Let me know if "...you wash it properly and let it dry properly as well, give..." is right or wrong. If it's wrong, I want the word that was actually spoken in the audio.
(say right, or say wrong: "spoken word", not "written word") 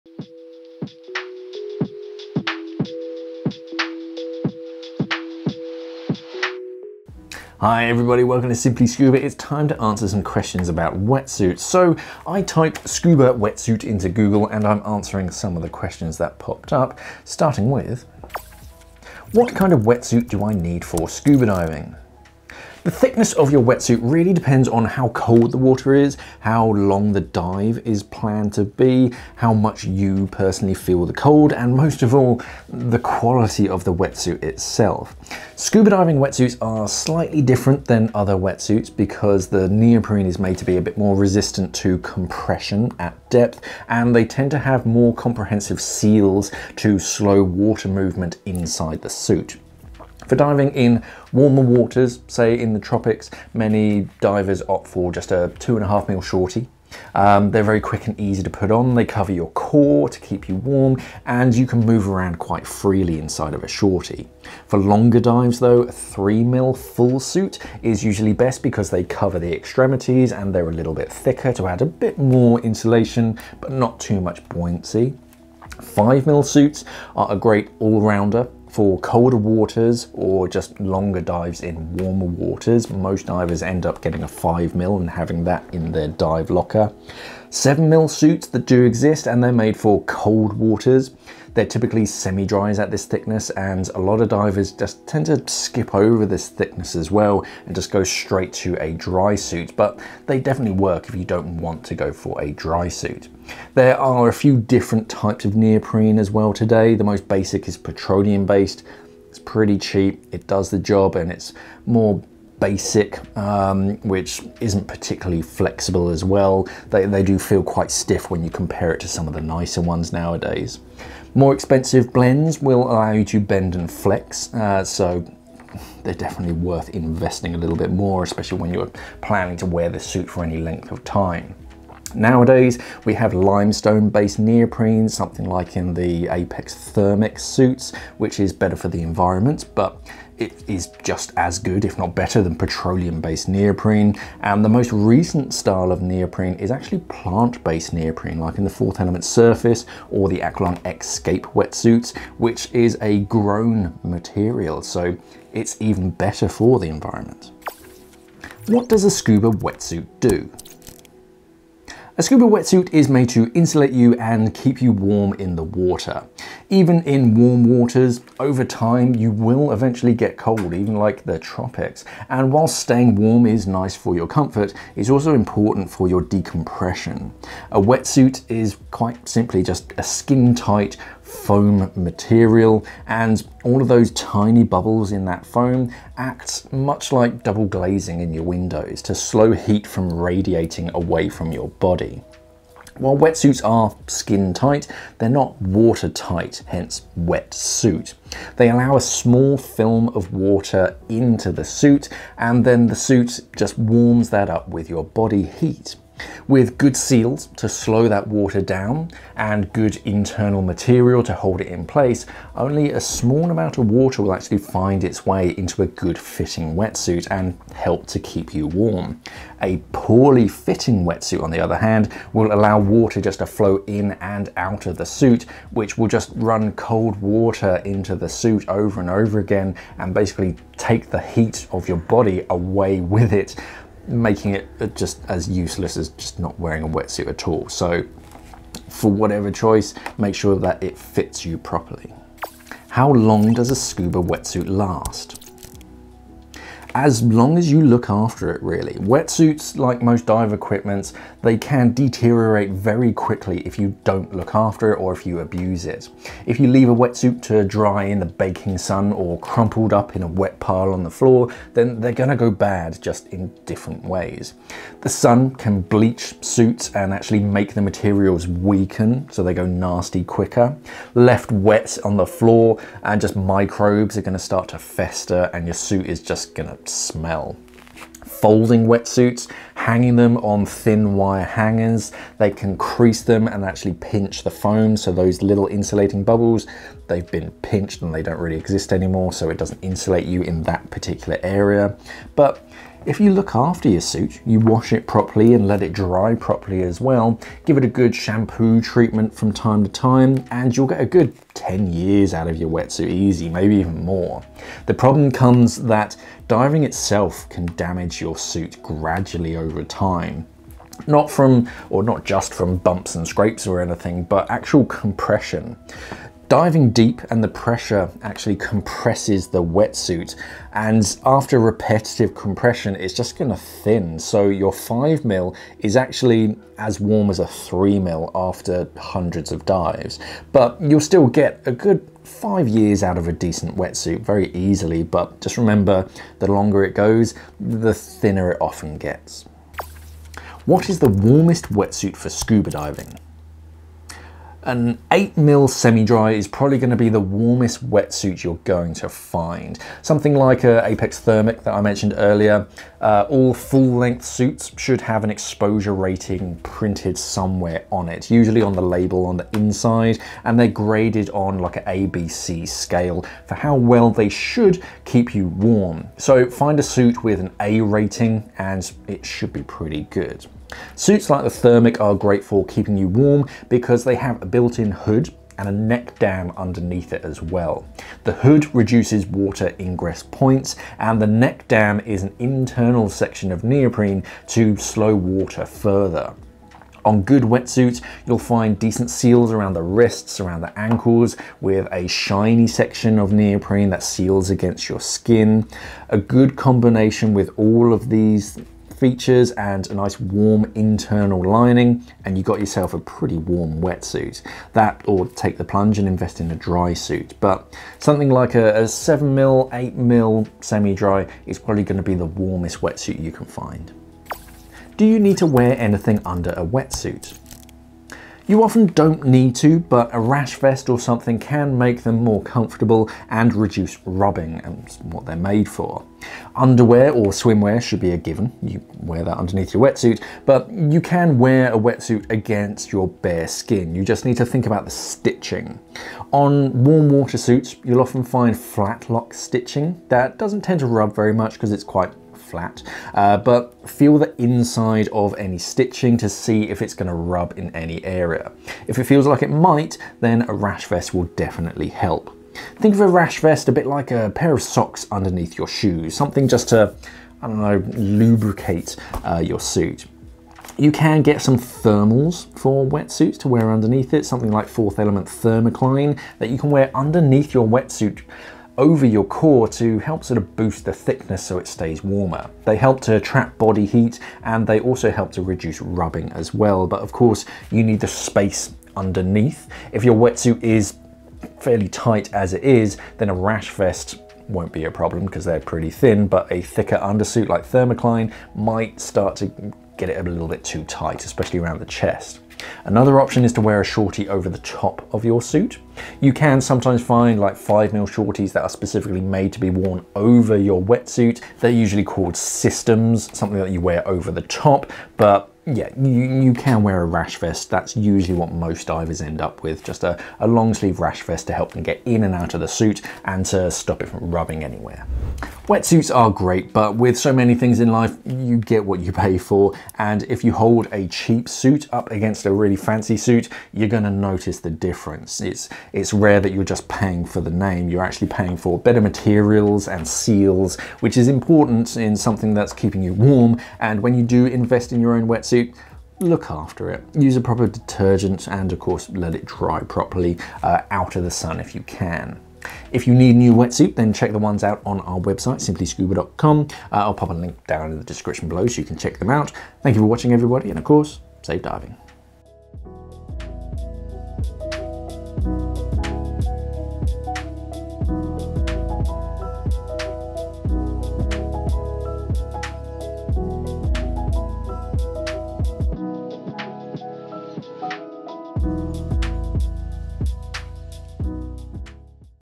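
right.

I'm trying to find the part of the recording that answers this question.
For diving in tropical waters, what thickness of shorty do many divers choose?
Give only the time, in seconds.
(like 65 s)
55 s.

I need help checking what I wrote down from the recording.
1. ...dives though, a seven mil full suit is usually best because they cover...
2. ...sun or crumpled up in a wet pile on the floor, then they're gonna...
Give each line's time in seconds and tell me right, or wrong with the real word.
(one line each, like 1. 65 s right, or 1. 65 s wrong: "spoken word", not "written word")
1. 65 s wrong: "three", not "seven"
2. 258 s right.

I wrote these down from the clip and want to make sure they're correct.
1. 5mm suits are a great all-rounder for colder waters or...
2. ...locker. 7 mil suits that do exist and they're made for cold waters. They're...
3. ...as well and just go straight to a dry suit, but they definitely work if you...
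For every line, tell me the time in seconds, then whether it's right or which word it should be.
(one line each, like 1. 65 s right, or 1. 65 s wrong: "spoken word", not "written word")
1. 75 s right
2. 86 s right
3. 96 s right.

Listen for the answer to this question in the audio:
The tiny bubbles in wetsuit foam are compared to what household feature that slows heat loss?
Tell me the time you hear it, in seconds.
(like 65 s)
187 s.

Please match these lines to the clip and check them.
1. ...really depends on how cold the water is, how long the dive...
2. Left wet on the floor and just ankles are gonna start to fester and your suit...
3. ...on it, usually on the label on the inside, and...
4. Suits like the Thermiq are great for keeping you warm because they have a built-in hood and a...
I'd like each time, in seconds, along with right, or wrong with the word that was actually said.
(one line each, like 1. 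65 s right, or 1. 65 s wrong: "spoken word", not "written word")
1. 24 s right
2. 271 s wrong: "microbes", not "ankles"
3. 357 s right
4. 370 s right.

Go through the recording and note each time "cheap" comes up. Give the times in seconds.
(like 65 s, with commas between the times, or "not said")
109 s, 521 s.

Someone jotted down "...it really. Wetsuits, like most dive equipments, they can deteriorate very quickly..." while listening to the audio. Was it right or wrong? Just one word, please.
right.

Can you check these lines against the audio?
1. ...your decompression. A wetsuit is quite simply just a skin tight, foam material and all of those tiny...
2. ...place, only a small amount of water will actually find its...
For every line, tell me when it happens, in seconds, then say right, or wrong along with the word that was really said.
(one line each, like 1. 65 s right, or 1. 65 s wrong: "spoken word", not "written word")
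1. 176 s right
2. 211 s right.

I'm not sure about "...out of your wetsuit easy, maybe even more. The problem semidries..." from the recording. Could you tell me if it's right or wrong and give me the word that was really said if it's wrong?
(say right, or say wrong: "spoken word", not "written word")
wrong: "comes", not "semidries".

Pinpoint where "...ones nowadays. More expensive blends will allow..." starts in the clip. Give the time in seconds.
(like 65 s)
119 s.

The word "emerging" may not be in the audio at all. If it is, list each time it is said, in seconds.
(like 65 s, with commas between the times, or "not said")
not said.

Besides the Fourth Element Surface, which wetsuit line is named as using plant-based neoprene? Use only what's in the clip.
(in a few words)
Aqualung Escape.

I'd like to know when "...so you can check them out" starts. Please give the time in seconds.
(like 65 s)
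548 s.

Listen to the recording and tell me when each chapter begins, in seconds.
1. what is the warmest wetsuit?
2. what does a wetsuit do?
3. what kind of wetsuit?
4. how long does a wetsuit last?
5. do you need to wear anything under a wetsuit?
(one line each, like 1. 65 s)
1. 339 s
2. 158 s
3. 18 s
4. 242 s
5. 414 s.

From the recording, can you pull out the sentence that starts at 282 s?
They can crease them and actually pinch the foam.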